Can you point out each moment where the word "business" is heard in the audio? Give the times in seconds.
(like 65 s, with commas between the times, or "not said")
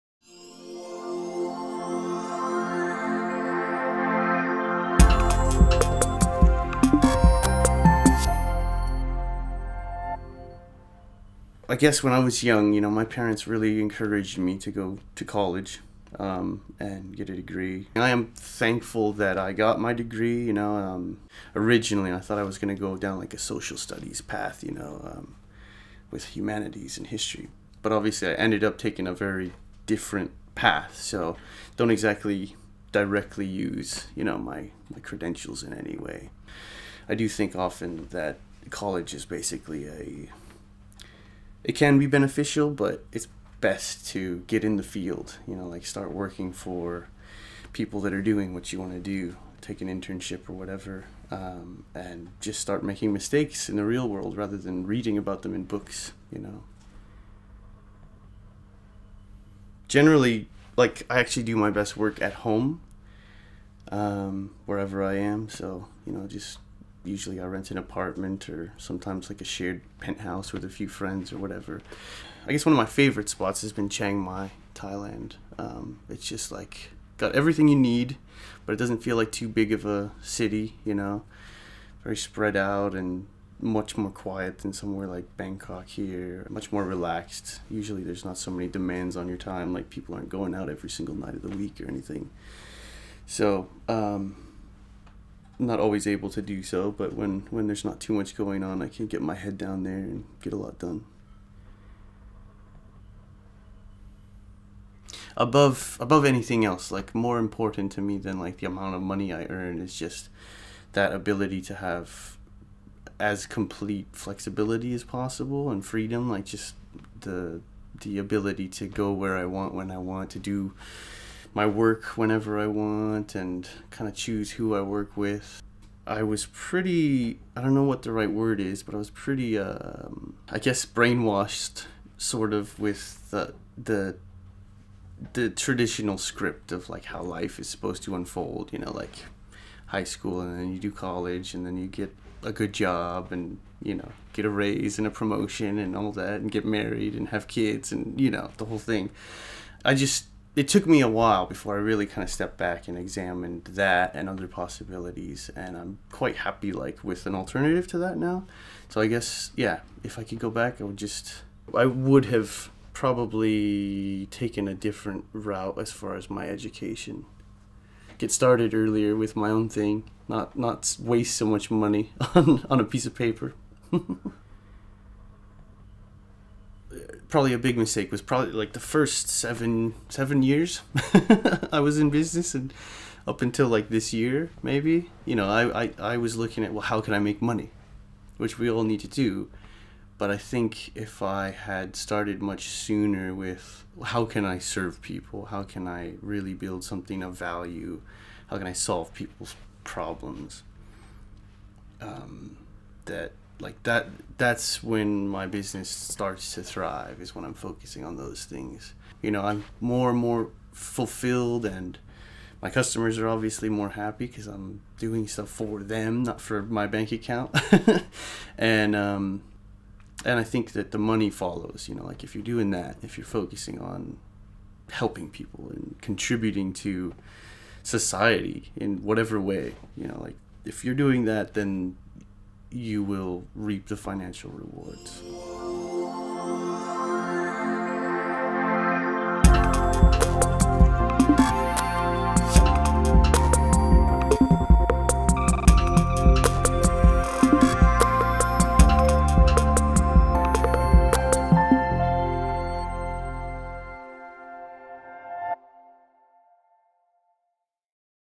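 182 s, 205 s.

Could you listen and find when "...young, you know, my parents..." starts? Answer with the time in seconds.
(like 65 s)
12 s.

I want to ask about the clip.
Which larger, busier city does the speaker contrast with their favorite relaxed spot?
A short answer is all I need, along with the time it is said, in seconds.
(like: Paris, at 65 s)
Bangkok, at 85 s.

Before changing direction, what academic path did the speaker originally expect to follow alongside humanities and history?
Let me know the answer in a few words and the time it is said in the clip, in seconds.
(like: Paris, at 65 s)
social studies, at 23 s.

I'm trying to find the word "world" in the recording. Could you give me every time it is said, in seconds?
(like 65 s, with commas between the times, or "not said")
54 s.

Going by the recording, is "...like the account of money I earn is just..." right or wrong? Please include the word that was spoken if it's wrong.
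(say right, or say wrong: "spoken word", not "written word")
wrong: "amount", not "account".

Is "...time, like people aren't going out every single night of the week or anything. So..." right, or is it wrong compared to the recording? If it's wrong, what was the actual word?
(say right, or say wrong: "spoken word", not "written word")
right.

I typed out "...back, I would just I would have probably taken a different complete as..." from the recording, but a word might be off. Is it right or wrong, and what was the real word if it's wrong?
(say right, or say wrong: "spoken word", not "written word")
wrong: "route", not "complete".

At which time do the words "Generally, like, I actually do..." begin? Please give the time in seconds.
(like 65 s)
59 s.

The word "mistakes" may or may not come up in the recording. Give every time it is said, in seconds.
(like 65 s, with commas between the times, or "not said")
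53 s, 177 s.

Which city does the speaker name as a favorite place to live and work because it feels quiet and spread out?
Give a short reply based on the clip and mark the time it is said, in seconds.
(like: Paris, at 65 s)
Chiang Mai, at 73 s.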